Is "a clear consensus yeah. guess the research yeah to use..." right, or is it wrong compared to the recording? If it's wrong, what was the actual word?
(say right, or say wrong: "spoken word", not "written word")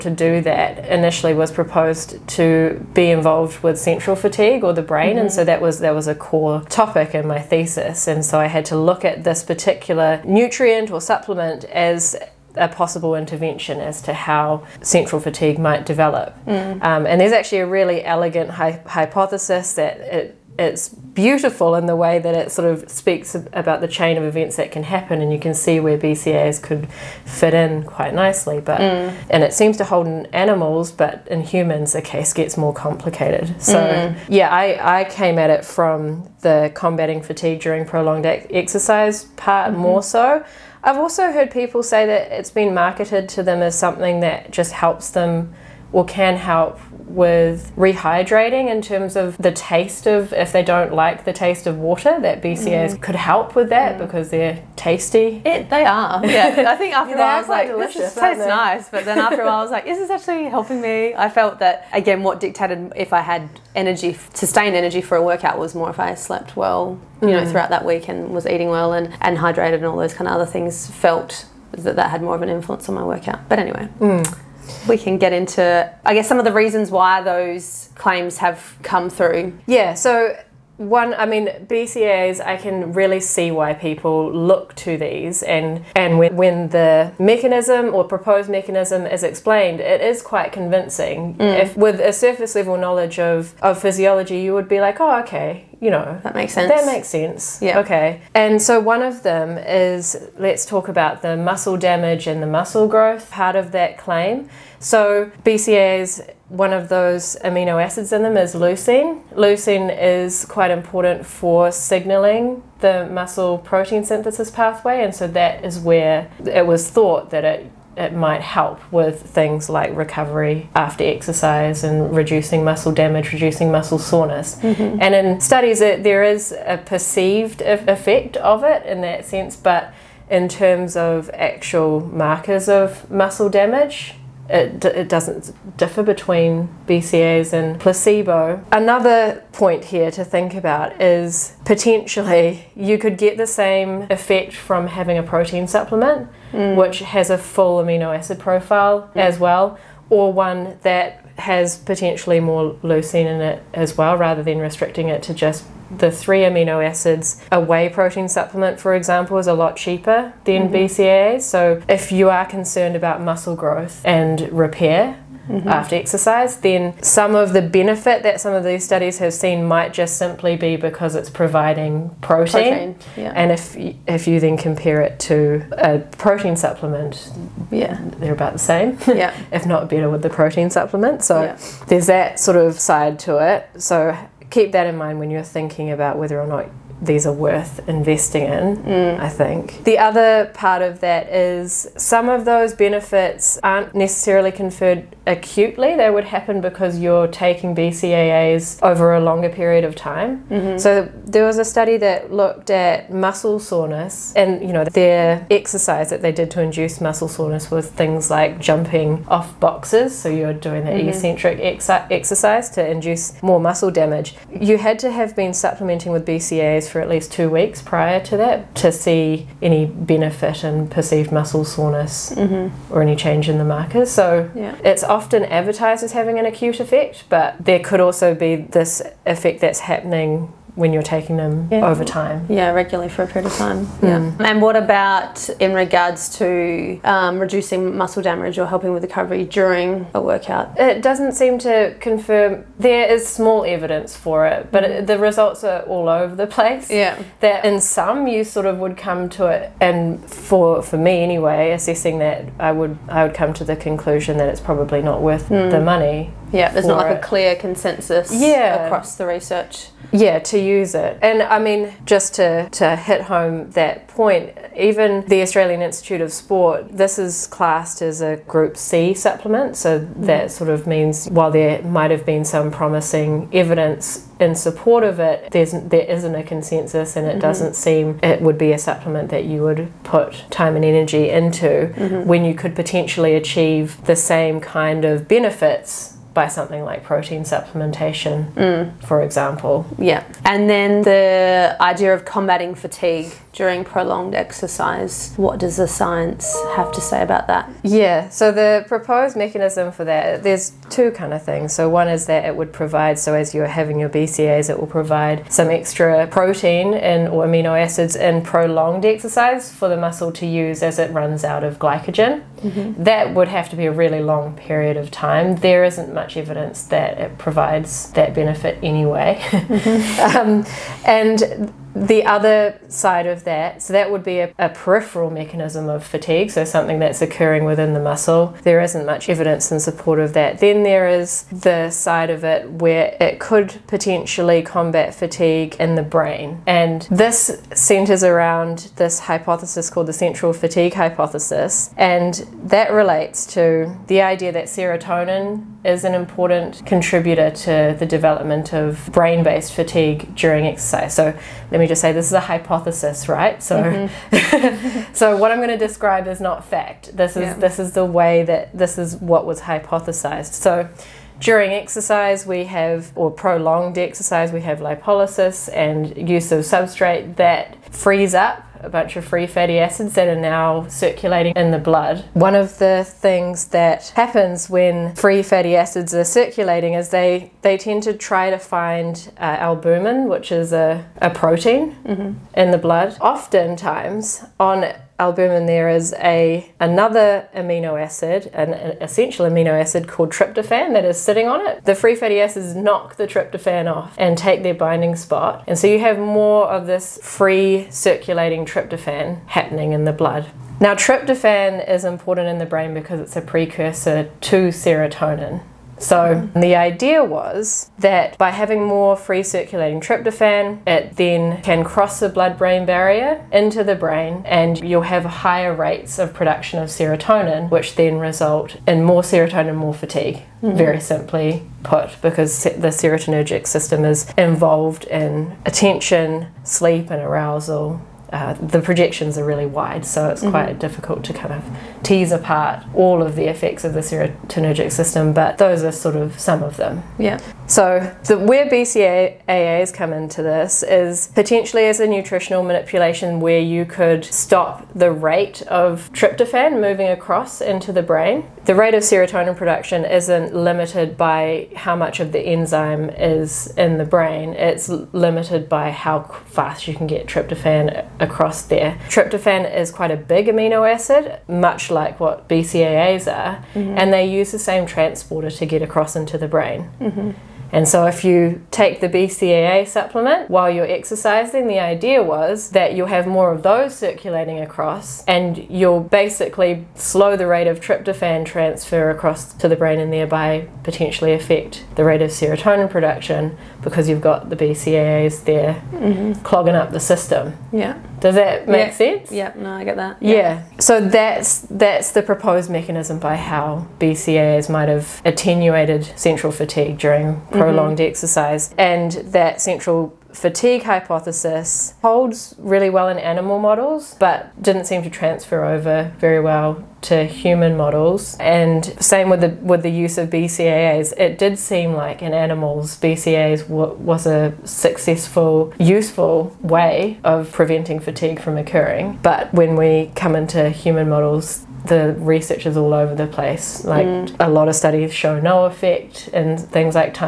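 wrong: "across", not "guess".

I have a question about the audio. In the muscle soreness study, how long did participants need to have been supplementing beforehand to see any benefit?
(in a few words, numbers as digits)
2 weeks.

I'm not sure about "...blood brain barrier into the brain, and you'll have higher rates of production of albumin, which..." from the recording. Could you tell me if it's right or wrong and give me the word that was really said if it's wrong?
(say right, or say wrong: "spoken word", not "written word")
wrong: "serotonin", not "albumin".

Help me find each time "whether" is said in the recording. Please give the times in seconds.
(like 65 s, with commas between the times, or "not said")
186 s.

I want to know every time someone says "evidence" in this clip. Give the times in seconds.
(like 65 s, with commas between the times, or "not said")
243 s, 273 s, 316 s, 329 s.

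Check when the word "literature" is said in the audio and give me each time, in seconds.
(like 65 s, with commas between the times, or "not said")
not said.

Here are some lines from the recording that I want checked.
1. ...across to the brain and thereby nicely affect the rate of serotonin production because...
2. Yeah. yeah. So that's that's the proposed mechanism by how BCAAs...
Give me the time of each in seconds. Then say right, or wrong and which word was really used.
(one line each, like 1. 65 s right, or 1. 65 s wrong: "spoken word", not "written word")
1. 479 s wrong: "potentially", not "nicely"
2. 490 s right.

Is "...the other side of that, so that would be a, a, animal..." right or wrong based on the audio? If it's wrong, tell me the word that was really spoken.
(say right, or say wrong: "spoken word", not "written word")
wrong: "peripheral", not "animal".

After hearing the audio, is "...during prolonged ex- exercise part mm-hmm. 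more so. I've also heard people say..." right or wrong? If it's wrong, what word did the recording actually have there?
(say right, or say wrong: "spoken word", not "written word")
right.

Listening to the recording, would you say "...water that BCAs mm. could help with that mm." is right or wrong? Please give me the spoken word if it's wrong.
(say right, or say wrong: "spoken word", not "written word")
right.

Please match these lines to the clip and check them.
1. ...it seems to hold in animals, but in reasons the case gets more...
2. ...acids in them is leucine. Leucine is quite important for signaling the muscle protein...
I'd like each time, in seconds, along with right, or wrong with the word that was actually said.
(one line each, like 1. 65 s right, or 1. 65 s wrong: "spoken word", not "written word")
1. 29 s wrong: "humans", not "reasons"
2. 107 s right.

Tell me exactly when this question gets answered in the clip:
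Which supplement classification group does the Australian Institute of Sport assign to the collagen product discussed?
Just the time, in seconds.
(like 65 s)
268 s.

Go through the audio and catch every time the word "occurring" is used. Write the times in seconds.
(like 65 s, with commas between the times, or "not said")
327 s, 518 s.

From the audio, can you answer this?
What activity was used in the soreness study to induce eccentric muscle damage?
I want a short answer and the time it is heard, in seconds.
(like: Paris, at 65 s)
Jumping off boxes, at 208 s.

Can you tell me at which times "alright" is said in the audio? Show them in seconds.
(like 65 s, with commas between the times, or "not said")
not said.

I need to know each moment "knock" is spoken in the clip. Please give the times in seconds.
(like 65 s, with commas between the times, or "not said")
392 s.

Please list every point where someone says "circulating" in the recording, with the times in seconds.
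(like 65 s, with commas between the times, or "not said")
370 s, 376 s, 397 s, 409 s, 473 s.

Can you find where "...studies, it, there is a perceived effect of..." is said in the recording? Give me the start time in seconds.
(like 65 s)
125 s.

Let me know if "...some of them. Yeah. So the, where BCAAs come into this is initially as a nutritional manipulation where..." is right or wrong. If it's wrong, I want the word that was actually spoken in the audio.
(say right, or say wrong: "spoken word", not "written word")
wrong: "potentially", not "initially".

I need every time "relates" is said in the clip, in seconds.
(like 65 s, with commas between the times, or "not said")
342 s.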